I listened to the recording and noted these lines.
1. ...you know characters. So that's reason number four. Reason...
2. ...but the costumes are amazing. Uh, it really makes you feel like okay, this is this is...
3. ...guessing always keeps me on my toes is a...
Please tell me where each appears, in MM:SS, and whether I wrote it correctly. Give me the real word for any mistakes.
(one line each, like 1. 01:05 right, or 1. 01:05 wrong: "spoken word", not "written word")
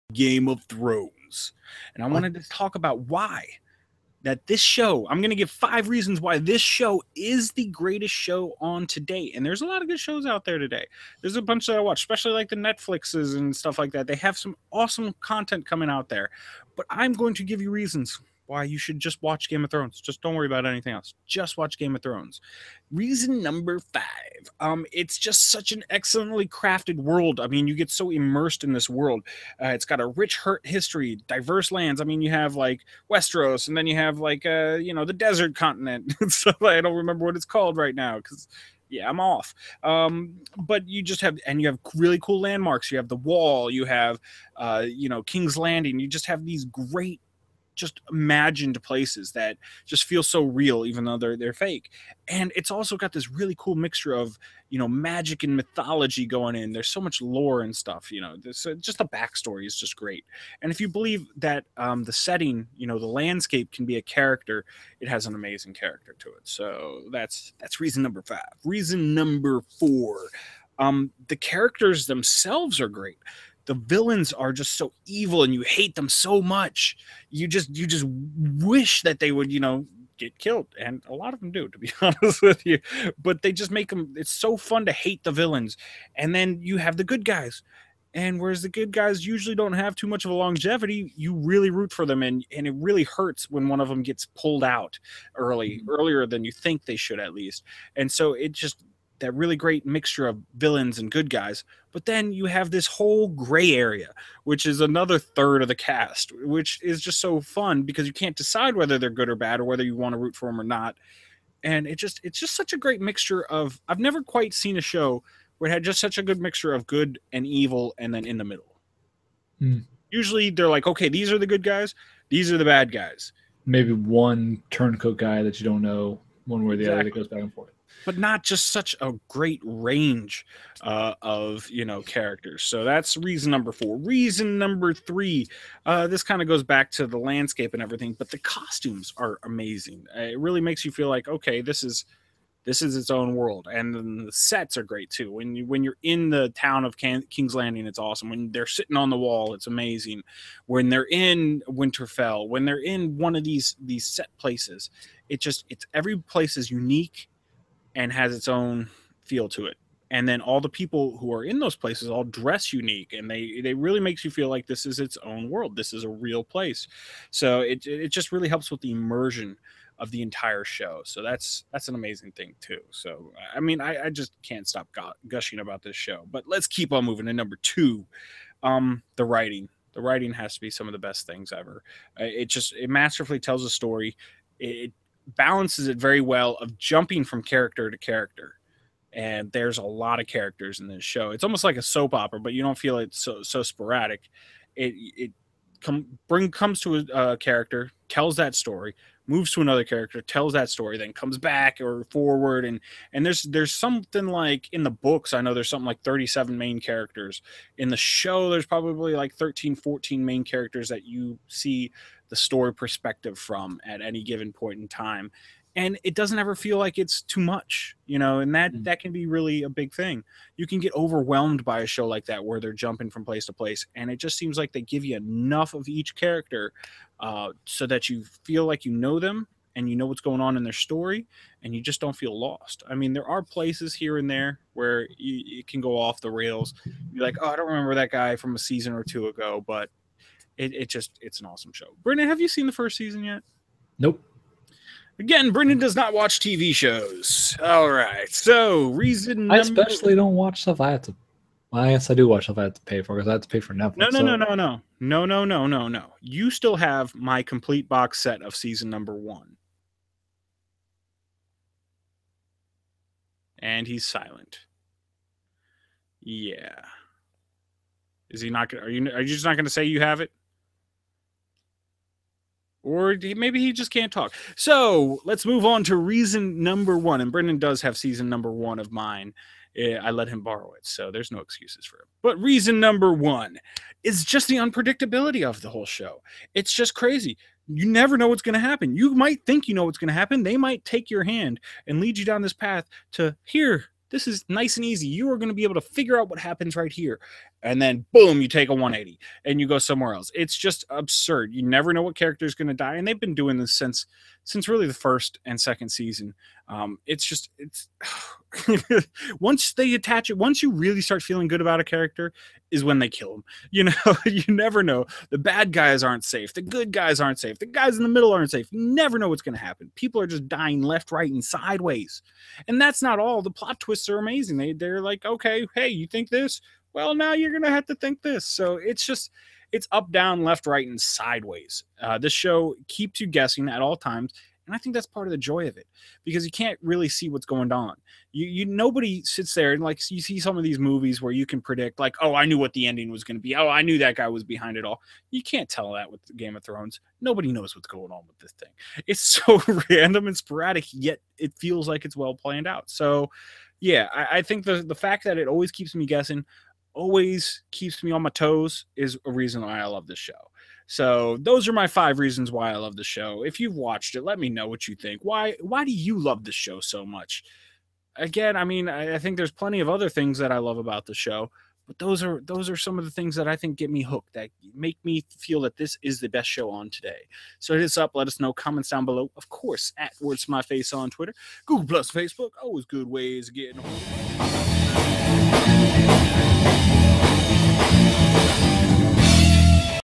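1. 02:11 right
2. 02:18 right
3. 05:56 right.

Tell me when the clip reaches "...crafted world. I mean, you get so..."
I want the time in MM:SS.
00:26.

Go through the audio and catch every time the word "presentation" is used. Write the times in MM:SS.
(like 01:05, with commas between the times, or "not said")
not said.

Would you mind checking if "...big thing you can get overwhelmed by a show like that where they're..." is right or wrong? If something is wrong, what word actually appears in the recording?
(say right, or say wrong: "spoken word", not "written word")
right.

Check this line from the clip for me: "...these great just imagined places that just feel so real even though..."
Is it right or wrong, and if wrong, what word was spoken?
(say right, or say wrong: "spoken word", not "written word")
right.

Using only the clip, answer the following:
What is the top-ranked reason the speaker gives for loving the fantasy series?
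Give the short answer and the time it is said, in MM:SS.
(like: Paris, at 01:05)
Unpredictability, at 04:44.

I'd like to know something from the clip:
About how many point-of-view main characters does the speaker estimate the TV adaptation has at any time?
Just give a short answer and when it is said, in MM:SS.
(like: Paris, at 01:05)
13 or 14, at 03:29.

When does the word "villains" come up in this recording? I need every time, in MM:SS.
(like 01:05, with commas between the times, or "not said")
01:13, 01:25, 01:40.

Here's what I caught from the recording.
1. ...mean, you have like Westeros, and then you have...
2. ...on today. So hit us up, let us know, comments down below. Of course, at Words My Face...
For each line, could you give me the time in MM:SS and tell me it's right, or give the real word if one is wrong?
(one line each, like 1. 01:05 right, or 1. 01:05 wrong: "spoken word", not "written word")
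1. 00:32 right
2. 06:16 right.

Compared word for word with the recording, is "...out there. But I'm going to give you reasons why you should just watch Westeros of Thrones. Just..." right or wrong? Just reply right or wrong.
wrong.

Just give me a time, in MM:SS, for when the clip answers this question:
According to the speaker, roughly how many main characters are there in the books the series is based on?
03:26.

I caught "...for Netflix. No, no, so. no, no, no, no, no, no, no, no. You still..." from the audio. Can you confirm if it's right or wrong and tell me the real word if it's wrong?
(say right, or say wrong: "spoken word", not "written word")
right.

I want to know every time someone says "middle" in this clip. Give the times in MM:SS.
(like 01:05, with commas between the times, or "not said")
01:58, 05:18.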